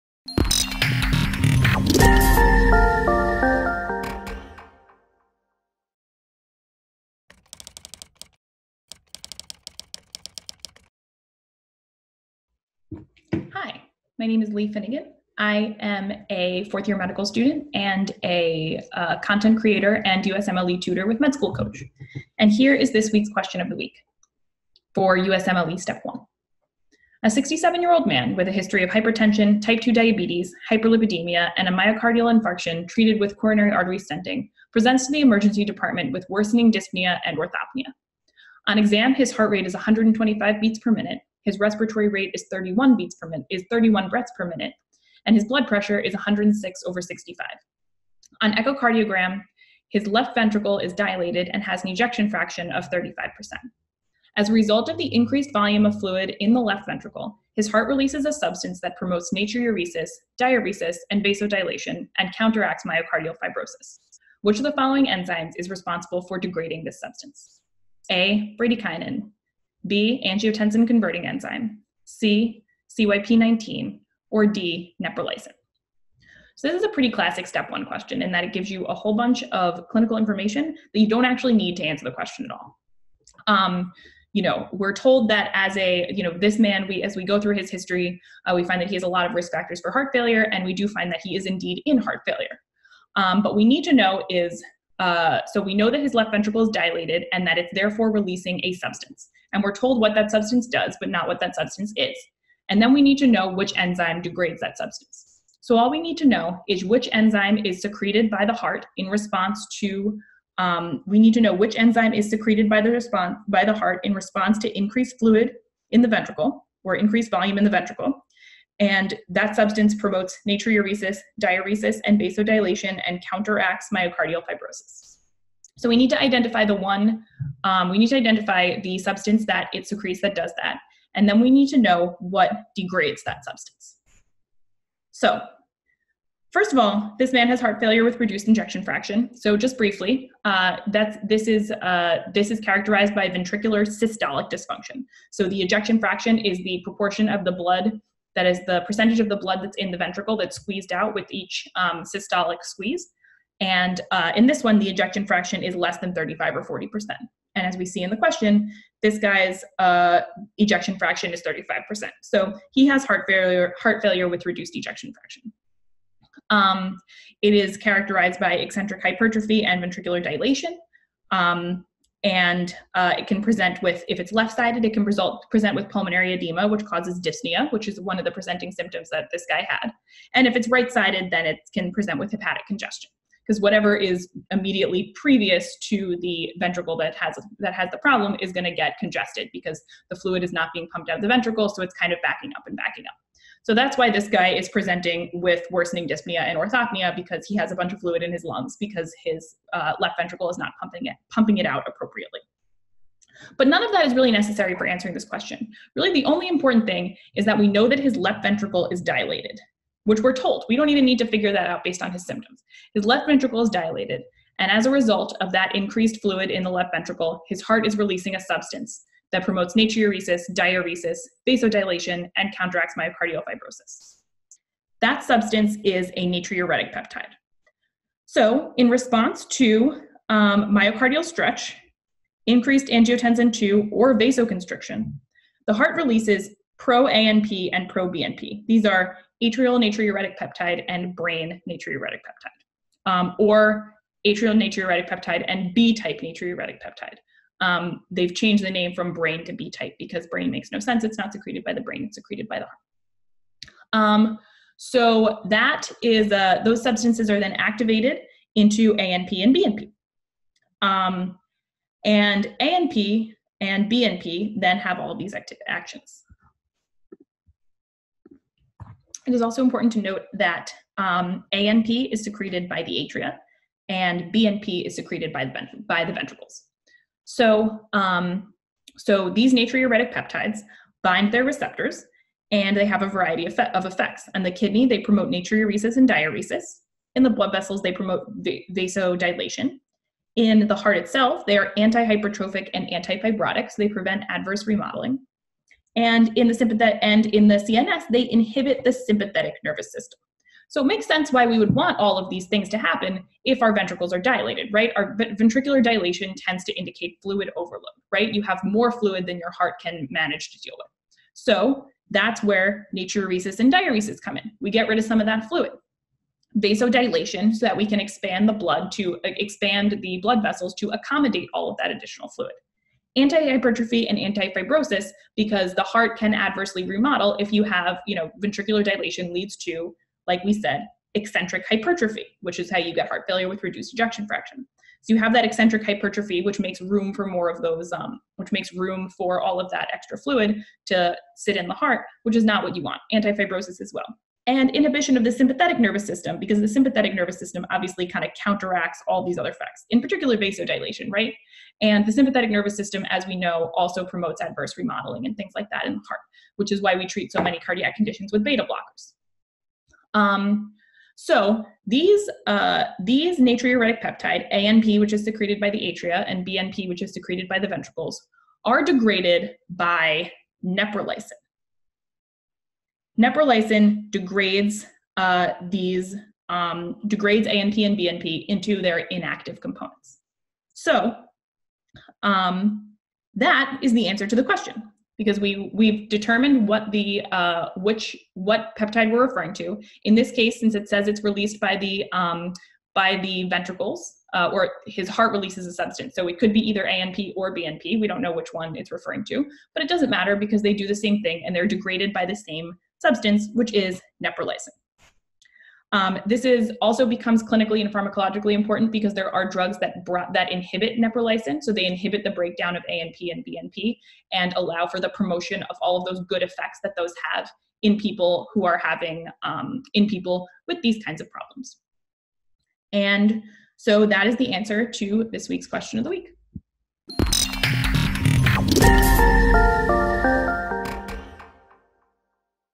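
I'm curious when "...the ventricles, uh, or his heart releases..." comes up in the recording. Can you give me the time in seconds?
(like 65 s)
393 s.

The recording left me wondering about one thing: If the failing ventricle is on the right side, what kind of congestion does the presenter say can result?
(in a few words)
Hepatic congestion.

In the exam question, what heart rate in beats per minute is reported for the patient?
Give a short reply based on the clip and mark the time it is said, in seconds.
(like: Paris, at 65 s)
125, at 39 s.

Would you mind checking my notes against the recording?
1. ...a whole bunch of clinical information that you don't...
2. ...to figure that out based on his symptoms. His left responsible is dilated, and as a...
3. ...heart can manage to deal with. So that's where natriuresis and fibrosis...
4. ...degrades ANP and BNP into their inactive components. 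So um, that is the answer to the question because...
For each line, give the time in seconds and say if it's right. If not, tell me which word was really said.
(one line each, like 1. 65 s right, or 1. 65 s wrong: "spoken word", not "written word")
1. 78 s right
2. 211 s wrong: "ventricle", not "responsible"
3. 309 s wrong: "diuresis", not "fibrosis"
4. 377 s right.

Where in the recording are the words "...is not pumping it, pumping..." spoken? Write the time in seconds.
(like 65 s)
200 s.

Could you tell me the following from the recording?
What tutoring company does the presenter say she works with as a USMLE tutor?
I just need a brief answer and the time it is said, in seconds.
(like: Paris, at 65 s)
Med School Coach, at 21 s.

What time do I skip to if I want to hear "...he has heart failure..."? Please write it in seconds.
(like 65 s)
162 s.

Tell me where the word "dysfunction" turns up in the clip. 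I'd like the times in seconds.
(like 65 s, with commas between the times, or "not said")
144 s.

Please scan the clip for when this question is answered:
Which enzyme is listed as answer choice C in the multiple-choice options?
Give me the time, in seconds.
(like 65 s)
72 s.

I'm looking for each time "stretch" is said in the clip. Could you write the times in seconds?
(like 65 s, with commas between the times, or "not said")
231 s.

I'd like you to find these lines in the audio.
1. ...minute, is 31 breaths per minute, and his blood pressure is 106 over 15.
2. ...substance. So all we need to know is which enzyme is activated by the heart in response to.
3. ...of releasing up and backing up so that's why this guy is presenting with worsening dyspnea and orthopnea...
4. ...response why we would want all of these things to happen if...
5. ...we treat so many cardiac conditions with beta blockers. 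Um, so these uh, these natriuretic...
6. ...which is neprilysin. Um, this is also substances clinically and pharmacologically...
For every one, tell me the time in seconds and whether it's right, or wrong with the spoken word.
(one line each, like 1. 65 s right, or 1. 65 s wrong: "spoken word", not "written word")
1. 43 s wrong: "65", not "15"
2. 104 s wrong: "secreted", not "activated"
3. 192 s wrong: "backing", not "releasing"
4. 301 s wrong: "sense", not "response"
5. 356 s right
6. 403 s wrong: "becomes", not "substances".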